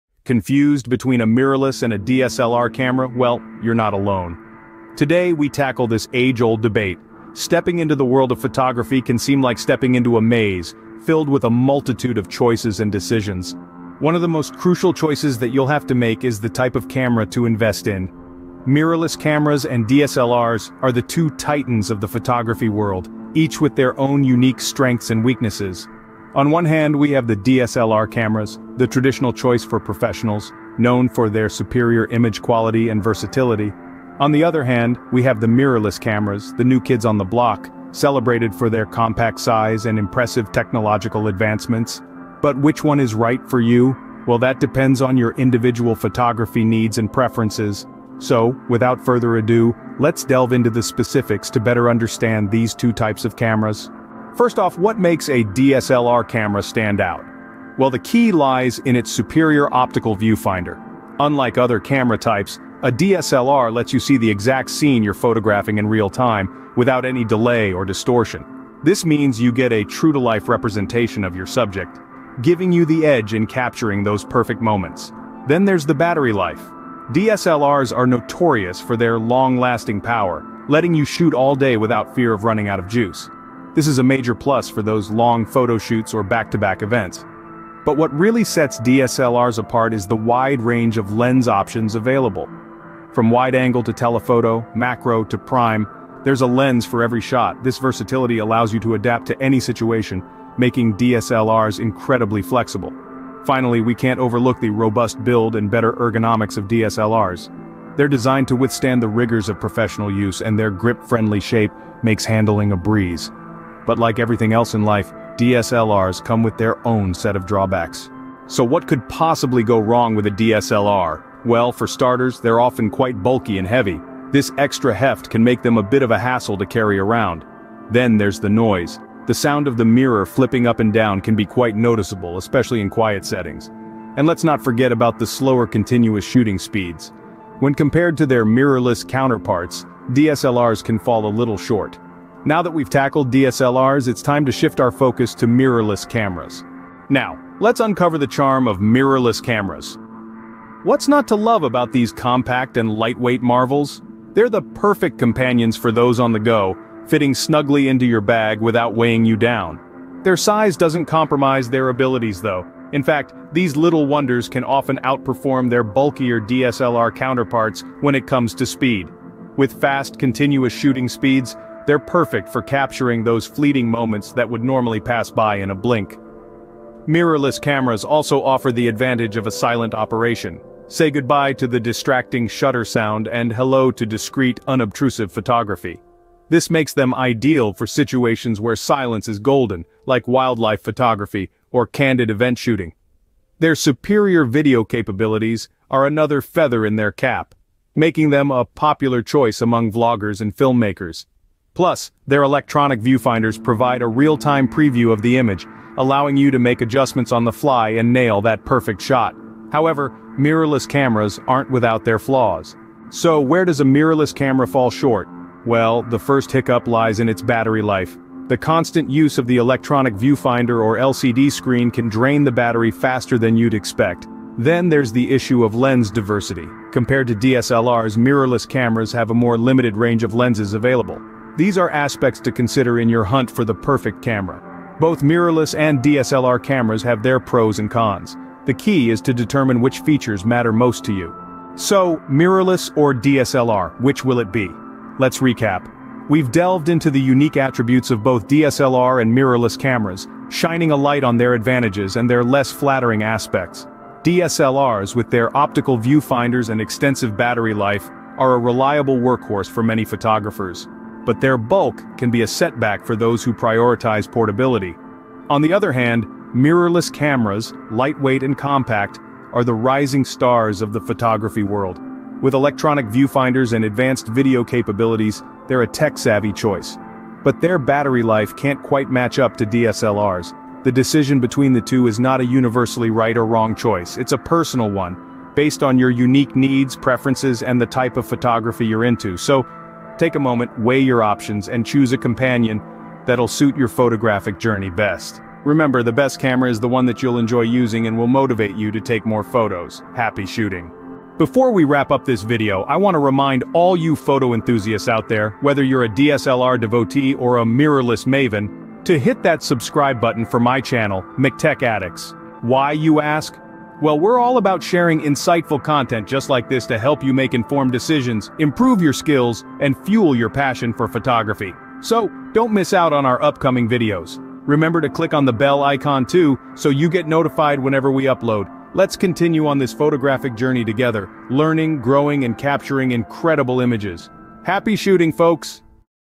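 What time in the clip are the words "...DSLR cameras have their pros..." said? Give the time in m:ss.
3:55.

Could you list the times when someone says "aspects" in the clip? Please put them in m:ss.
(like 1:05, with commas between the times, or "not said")
3:51, 4:13.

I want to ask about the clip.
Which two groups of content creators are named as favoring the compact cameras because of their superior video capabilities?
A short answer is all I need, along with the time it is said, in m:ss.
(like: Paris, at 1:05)
vloggers and filmmakers, at 3:19.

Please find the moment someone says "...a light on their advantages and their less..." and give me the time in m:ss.
4:10.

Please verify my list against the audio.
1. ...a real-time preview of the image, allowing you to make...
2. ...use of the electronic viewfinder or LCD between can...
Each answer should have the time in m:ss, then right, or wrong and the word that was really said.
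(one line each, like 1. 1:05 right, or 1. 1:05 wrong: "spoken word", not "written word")
1. 3:24 right
2. 3:39 wrong: "screen", not "between".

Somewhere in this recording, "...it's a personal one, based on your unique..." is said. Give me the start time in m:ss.
4:44.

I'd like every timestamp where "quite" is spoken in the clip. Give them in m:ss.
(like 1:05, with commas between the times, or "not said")
2:02, 2:11, 4:38.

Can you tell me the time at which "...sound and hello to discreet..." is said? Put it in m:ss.
3:02.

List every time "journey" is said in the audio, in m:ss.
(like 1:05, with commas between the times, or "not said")
4:54, 5:30.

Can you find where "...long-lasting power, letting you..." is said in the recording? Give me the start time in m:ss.
1:19.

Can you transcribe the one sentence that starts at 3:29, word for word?
However, mirrorless cameras aren't without their flaws.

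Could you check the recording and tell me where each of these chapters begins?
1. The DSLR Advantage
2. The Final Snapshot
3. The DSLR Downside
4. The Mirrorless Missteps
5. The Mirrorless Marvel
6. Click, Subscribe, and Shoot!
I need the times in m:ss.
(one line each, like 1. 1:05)
1. 0:54
2. 4:01
3. 1:58
4. 3:32
5. 2:26
6. 5:01.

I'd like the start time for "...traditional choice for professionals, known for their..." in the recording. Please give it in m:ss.
0:28.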